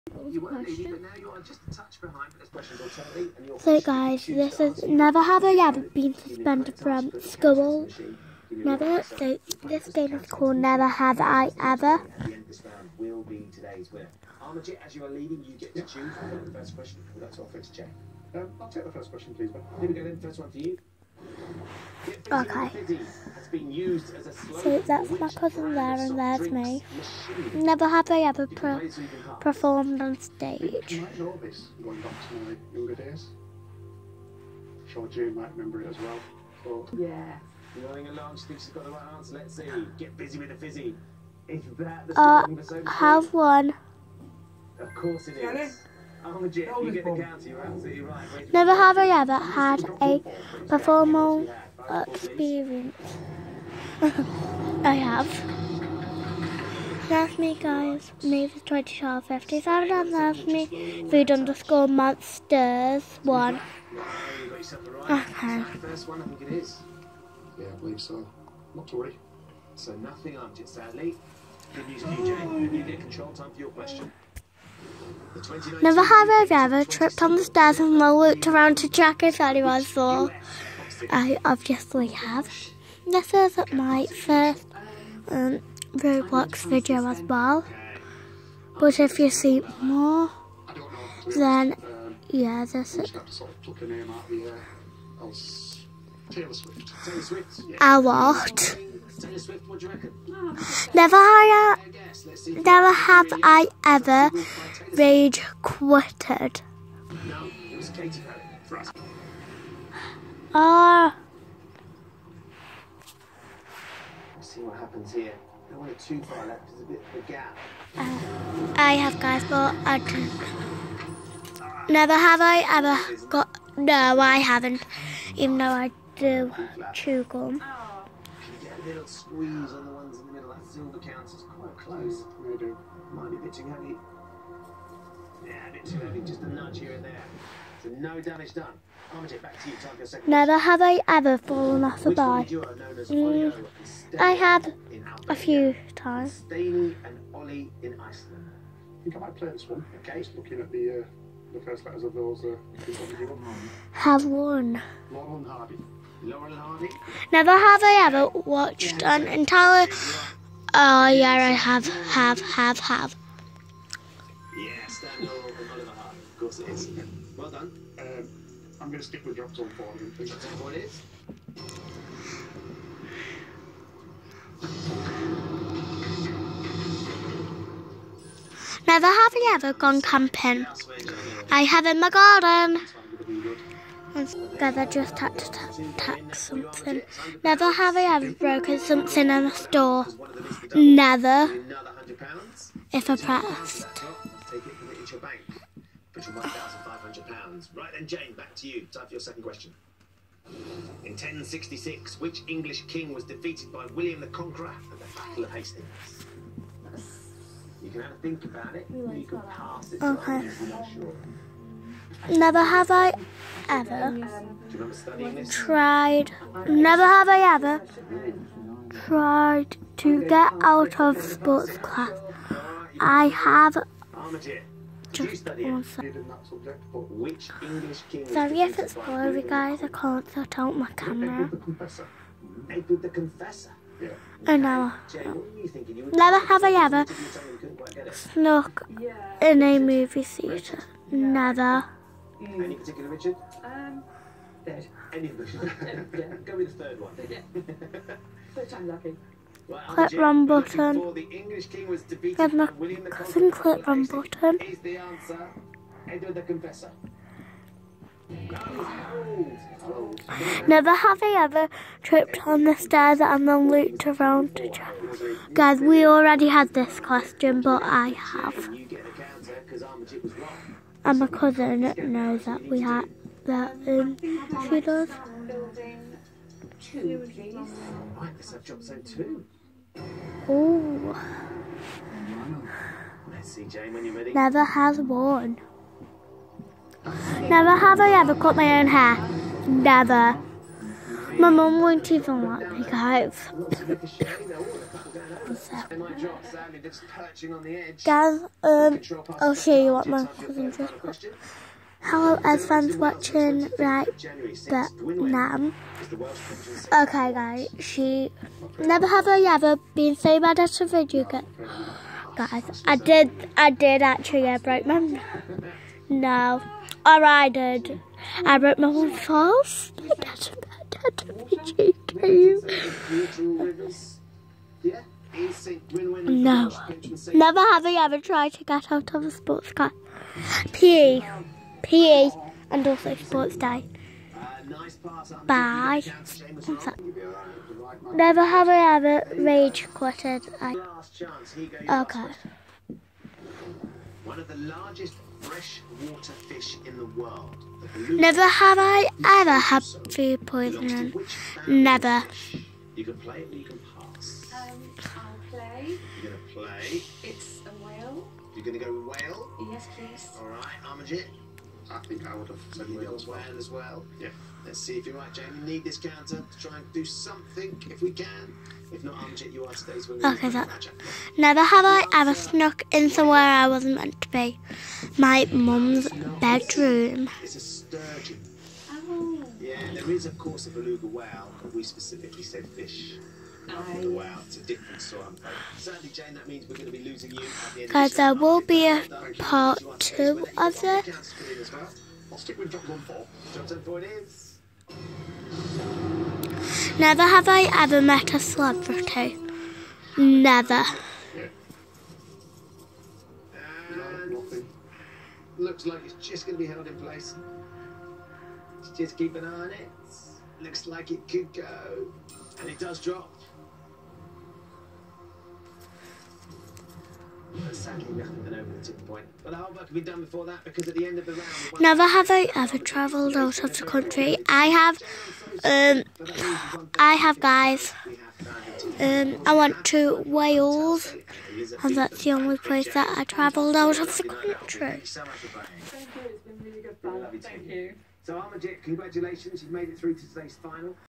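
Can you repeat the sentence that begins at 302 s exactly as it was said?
Hello everyone's watching right but now.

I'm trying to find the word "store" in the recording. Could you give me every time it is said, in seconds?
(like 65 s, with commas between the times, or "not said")
189 s.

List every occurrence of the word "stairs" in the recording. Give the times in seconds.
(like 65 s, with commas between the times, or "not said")
77 s, 262 s.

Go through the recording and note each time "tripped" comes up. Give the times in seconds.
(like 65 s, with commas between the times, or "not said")
76 s, 262 s.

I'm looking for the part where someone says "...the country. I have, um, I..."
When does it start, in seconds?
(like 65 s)
423 s.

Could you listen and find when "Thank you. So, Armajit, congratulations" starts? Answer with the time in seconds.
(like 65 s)
437 s.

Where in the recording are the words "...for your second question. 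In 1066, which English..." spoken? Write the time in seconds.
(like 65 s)
199 s.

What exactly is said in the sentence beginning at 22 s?
Okay been used as a So that's my cousin there and there's me.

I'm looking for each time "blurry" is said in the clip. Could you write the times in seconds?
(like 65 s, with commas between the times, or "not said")
228 s.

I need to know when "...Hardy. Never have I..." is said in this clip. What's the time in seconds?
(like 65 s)
156 s.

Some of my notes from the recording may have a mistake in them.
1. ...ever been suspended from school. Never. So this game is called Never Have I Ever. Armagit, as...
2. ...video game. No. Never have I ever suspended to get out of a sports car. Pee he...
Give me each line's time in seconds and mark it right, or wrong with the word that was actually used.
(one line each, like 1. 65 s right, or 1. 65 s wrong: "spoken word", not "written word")
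1. 5 s right
2. 321 s wrong: "tried", not "suspended".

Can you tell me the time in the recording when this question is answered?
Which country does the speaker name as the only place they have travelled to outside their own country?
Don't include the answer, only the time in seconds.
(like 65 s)
430 s.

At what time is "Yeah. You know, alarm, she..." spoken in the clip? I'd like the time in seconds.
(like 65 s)
36 s.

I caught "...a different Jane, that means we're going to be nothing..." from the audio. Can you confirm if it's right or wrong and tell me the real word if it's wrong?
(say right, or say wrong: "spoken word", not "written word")
wrong: "losing", not "nothing".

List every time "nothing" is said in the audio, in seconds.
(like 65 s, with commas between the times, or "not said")
69 s, 417 s.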